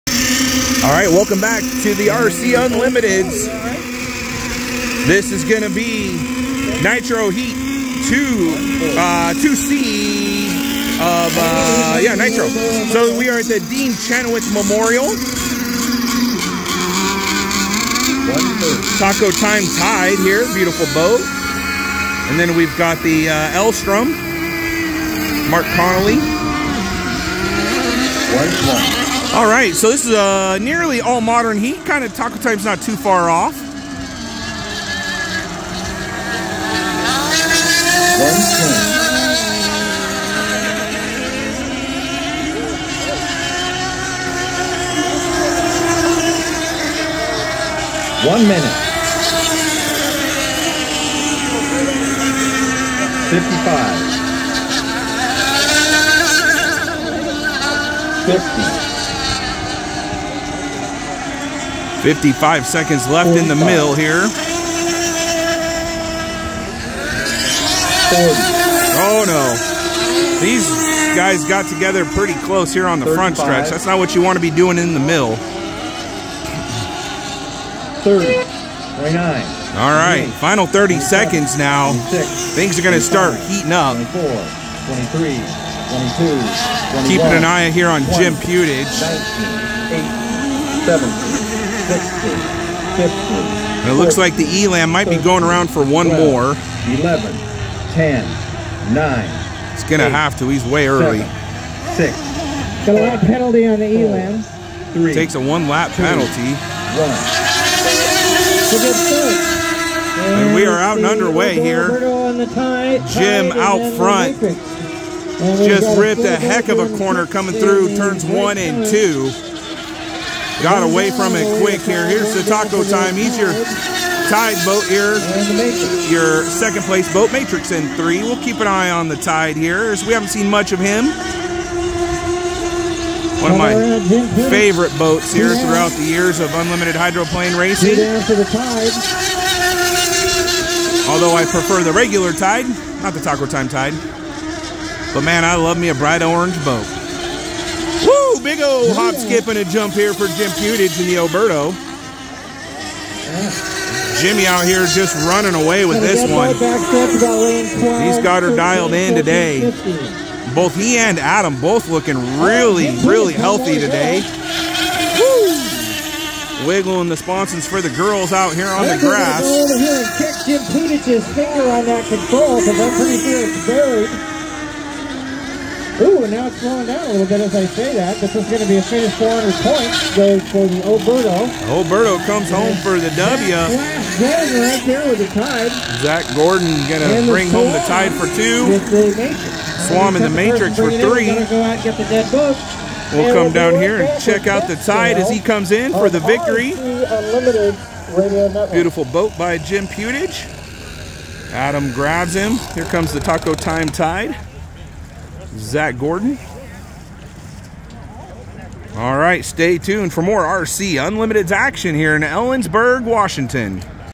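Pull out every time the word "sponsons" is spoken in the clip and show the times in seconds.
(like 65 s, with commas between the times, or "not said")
167 s.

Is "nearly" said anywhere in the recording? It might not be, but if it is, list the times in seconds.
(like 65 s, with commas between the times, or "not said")
30 s.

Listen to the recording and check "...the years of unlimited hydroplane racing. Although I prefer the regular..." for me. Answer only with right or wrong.
right.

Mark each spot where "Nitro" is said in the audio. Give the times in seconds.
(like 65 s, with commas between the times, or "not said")
6 s, 12 s.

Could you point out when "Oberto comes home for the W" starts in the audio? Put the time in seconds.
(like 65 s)
181 s.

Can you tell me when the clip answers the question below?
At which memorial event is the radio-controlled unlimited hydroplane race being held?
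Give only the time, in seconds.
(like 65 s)
13 s.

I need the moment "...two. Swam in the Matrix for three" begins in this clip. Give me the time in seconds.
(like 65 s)
188 s.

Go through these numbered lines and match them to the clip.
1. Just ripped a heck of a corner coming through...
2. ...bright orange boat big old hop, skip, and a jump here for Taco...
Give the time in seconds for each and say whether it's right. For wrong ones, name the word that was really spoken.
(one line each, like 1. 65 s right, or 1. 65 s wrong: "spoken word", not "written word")
1. 115 s right
2. 145 s wrong: "Jim", not "Taco".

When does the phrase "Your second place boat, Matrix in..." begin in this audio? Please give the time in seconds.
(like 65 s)
126 s.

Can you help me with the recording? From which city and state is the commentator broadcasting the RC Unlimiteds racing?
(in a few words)
Ellensburg, Washington.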